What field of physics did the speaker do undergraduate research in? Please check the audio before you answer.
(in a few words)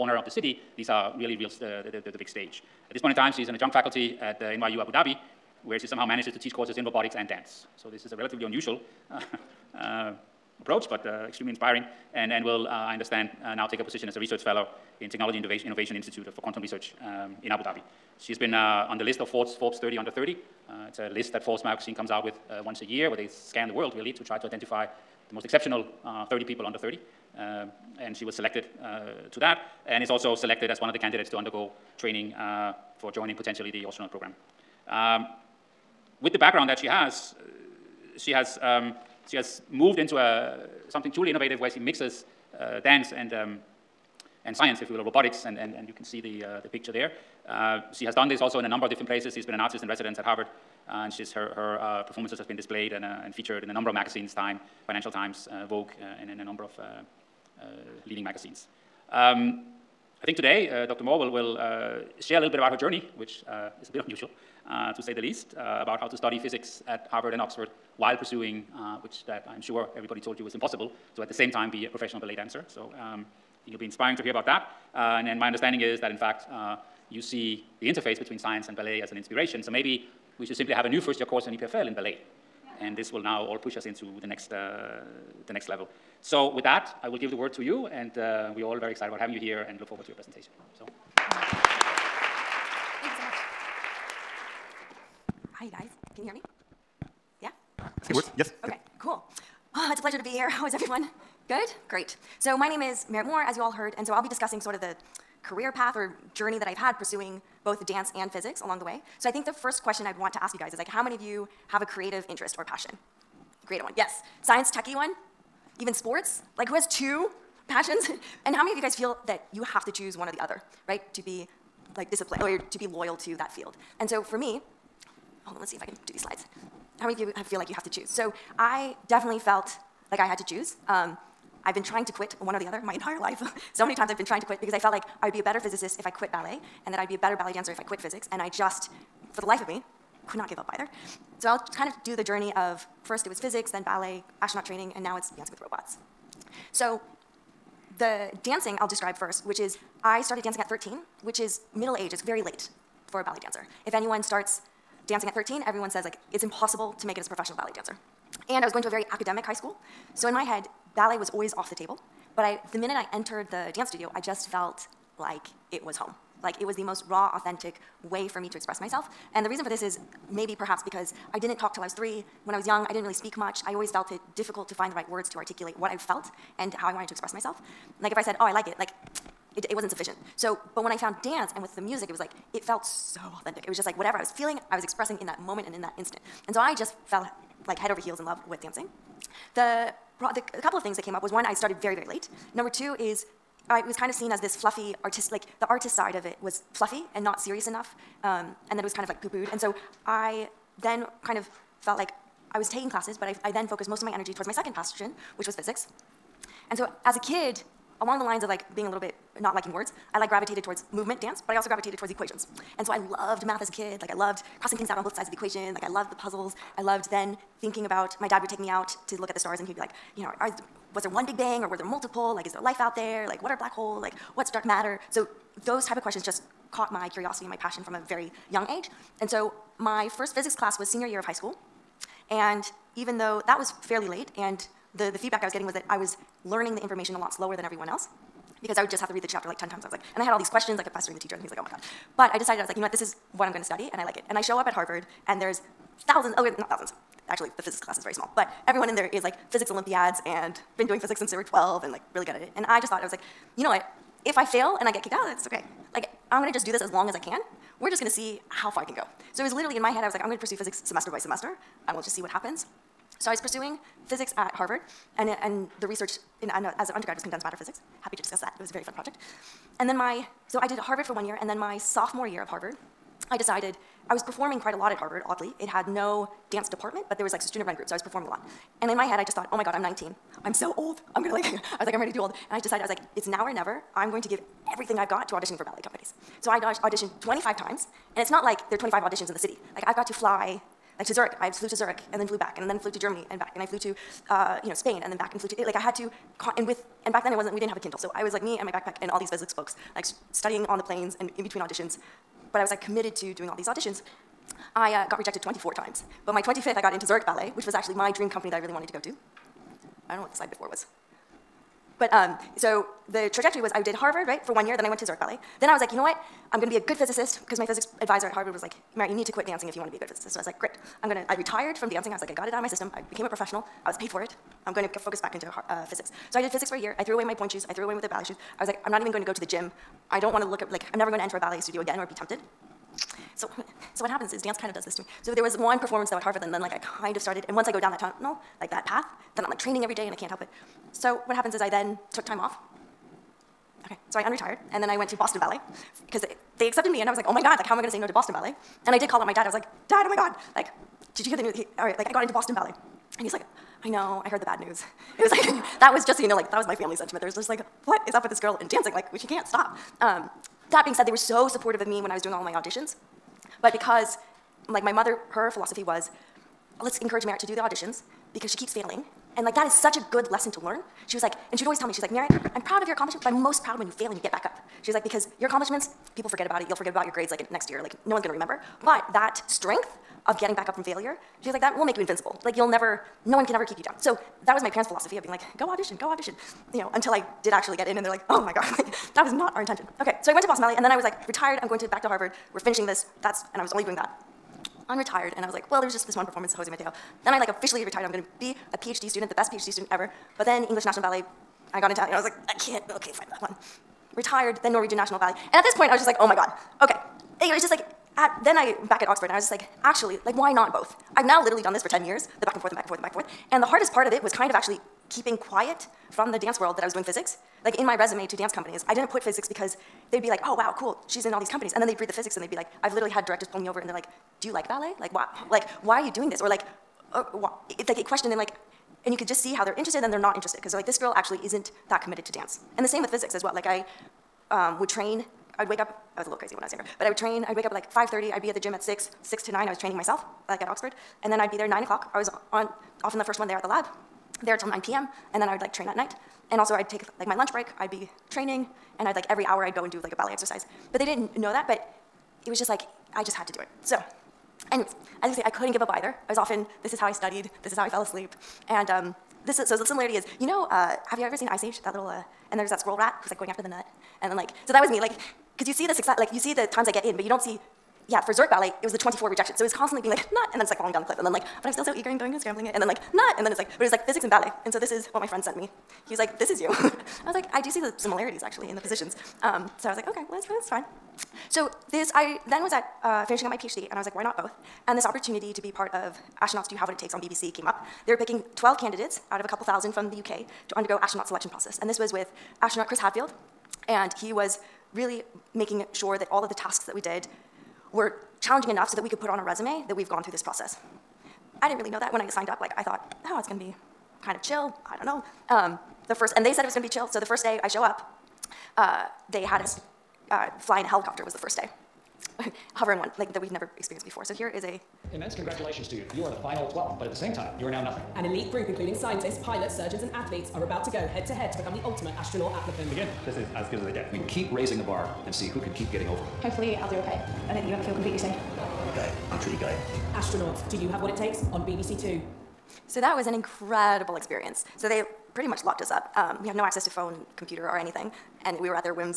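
Condensed matter physics.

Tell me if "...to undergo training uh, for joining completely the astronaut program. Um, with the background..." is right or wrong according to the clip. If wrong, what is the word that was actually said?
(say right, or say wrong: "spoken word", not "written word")
wrong: "potentially", not "completely".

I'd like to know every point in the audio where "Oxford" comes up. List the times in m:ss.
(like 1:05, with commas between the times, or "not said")
1:07, 6:49, 7:20.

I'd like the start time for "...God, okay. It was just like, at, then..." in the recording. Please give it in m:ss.
6:46.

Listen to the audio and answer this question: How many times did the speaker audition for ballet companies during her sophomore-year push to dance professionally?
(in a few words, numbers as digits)
25.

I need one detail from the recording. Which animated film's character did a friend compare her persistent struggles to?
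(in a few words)
Ice Age.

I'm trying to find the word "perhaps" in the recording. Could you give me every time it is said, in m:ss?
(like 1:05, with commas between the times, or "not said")
2:50.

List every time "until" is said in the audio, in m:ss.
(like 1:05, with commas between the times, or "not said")
6:26.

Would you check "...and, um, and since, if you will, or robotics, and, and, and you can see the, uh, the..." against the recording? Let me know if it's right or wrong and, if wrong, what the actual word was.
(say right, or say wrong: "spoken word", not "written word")
wrong: "science", not "since".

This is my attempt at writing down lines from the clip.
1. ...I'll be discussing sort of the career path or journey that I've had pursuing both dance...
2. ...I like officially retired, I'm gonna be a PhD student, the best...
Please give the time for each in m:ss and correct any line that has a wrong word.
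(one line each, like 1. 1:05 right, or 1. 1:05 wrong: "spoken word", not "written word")
1. 1:44 right
2. 6:37 right.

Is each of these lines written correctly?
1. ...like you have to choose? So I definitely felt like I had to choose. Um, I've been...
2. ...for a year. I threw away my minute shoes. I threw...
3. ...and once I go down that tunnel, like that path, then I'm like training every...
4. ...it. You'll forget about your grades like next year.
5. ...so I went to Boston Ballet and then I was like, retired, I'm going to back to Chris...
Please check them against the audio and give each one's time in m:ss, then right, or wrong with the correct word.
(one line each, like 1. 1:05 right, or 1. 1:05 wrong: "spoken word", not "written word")
1. 2:07 right
2. 5:26 wrong: "pointe", not "minute"
3. 5:37 right
4. 6:16 right
5. 6:30 wrong: "Harvard", not "Chris".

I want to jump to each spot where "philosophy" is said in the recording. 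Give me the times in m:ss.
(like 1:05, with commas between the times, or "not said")
6:05, 6:24.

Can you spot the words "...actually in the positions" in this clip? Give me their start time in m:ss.
7:58.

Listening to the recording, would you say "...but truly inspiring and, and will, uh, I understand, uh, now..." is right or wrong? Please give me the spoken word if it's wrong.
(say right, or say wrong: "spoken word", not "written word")
wrong: "extremely", not "truly".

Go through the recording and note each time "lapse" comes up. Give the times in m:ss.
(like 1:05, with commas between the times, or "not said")
not said.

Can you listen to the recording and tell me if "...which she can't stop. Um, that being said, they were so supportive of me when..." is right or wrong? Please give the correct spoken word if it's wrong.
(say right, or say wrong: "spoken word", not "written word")
right.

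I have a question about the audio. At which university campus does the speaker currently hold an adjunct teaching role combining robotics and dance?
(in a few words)
NYU Abu Dhabi.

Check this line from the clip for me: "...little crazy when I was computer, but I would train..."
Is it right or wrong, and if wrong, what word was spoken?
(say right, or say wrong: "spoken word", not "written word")
wrong: "younger", not "computer".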